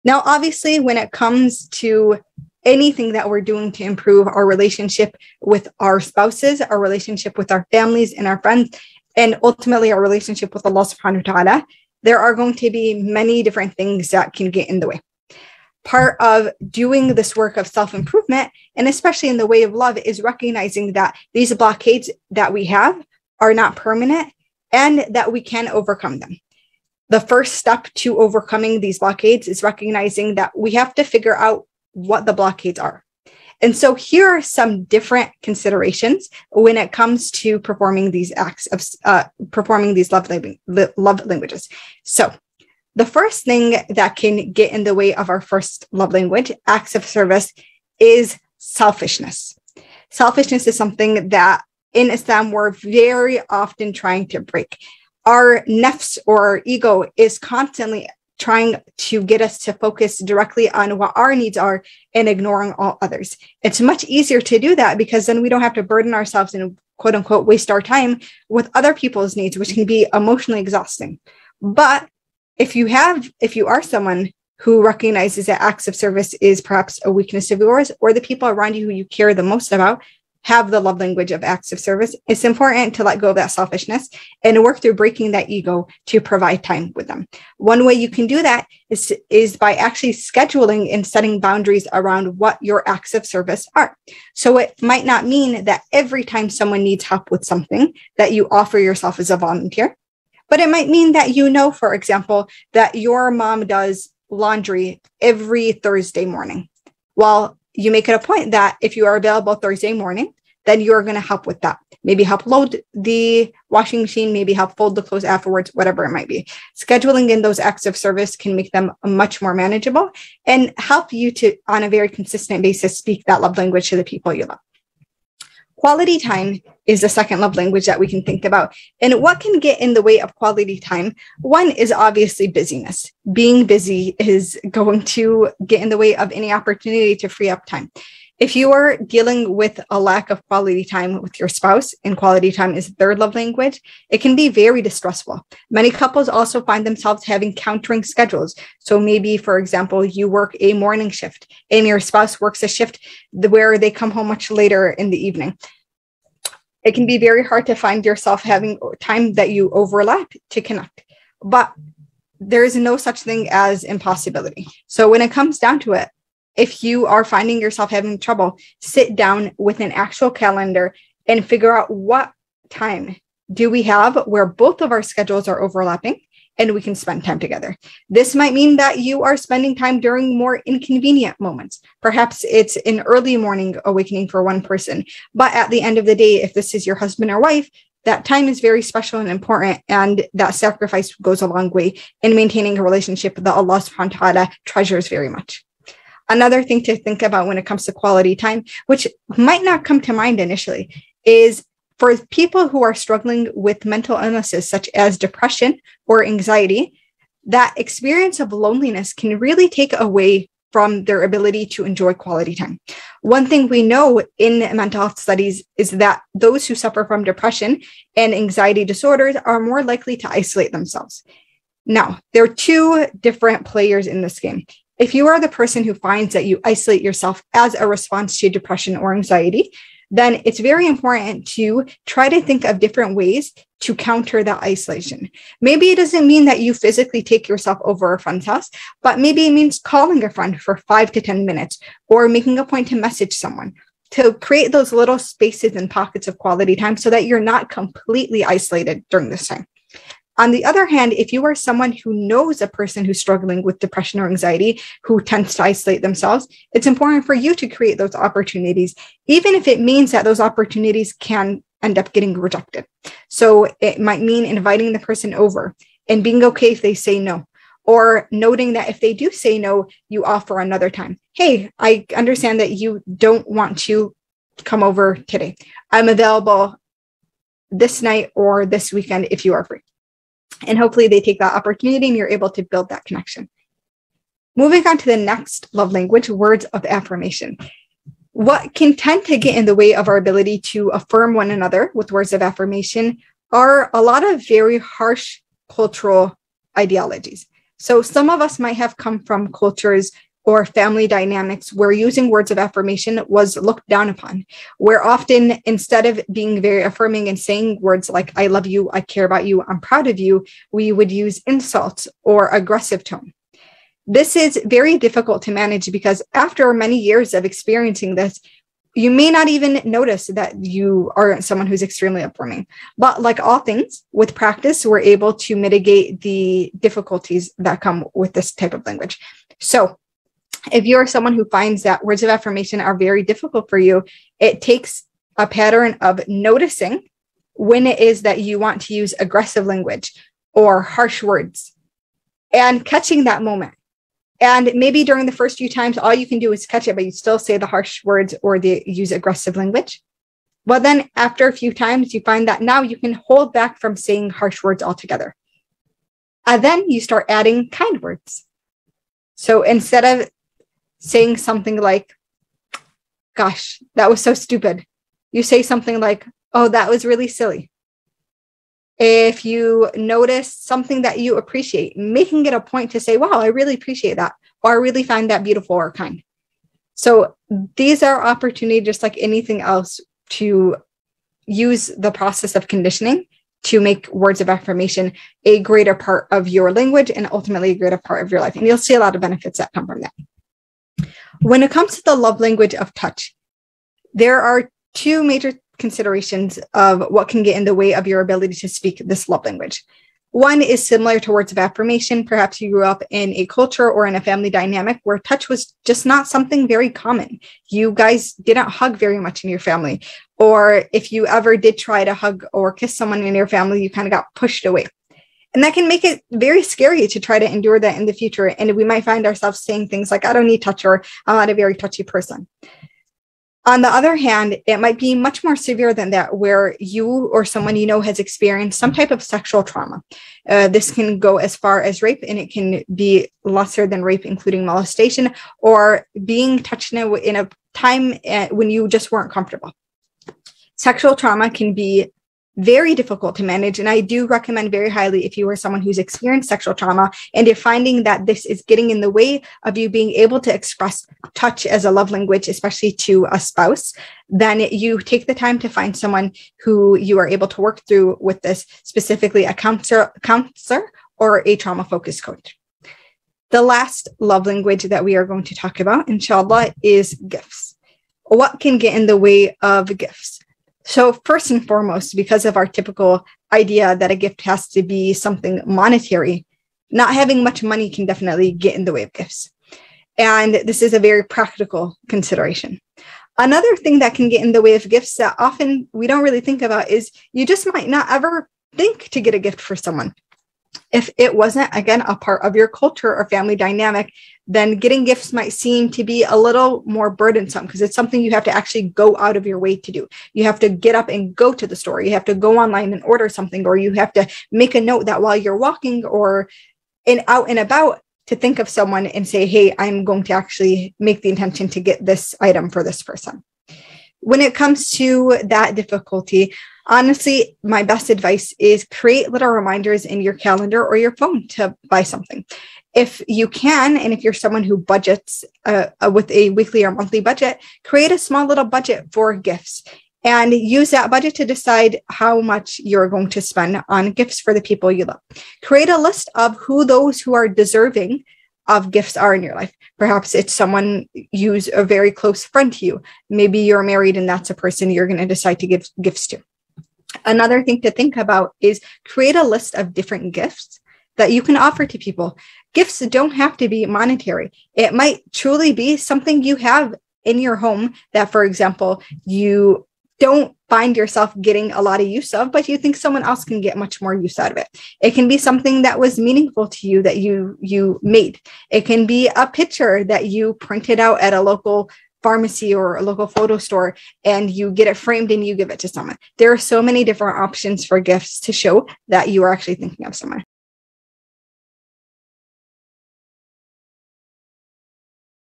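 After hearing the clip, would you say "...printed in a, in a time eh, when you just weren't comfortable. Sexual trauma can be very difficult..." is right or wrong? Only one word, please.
wrong.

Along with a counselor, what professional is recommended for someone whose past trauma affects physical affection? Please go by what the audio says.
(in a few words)
Trauma focused coach.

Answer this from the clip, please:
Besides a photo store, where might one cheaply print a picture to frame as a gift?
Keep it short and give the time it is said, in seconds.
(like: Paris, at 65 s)
A local pharmacy, at 571 s.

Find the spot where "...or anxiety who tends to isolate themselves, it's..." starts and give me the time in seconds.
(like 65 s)
254 s.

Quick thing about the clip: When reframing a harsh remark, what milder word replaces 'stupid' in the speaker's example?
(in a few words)
Silly.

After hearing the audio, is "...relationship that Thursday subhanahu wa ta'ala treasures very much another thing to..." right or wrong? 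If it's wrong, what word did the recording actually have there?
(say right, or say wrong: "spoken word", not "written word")
wrong: "Allah", not "Thursday".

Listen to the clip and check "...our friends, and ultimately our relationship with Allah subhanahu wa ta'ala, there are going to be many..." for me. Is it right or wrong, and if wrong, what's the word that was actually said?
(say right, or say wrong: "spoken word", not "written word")
right.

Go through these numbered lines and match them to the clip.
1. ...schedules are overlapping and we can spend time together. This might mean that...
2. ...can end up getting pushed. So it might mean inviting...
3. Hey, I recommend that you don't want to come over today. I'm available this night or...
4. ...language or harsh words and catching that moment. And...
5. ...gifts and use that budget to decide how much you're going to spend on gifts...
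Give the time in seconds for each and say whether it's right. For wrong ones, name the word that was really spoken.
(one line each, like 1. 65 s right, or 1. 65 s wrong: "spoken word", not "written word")
1. 175 s right
2. 261 s wrong: "rejected", not "pushed"
3. 271 s wrong: "understand", not "recommend"
4. 339 s right
5. 529 s right.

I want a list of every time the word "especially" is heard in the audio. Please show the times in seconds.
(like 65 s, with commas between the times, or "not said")
18 s, 452 s.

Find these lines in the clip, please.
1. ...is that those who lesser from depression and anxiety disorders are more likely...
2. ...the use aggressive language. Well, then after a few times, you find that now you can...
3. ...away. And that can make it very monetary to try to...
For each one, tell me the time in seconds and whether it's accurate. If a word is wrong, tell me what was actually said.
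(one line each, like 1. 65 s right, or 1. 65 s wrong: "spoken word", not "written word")
1. 215 s wrong: "suffer", not "lesser"
2. 348 s right
3. 414 s wrong: "scary", not "monetary".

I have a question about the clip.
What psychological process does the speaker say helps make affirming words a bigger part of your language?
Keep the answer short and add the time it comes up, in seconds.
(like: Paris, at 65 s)
Conditioning, at 382 s.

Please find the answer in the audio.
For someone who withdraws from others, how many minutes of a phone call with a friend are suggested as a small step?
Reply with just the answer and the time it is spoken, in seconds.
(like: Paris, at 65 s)
5 to 10, at 240 s.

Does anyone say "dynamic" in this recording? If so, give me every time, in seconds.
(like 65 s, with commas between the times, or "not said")
301 s, 404 s, 493 s.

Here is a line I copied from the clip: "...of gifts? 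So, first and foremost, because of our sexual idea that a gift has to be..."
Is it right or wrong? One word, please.
wrong.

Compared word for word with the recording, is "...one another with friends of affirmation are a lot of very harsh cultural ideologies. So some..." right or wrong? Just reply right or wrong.
wrong.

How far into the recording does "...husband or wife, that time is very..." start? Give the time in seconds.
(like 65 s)
186 s.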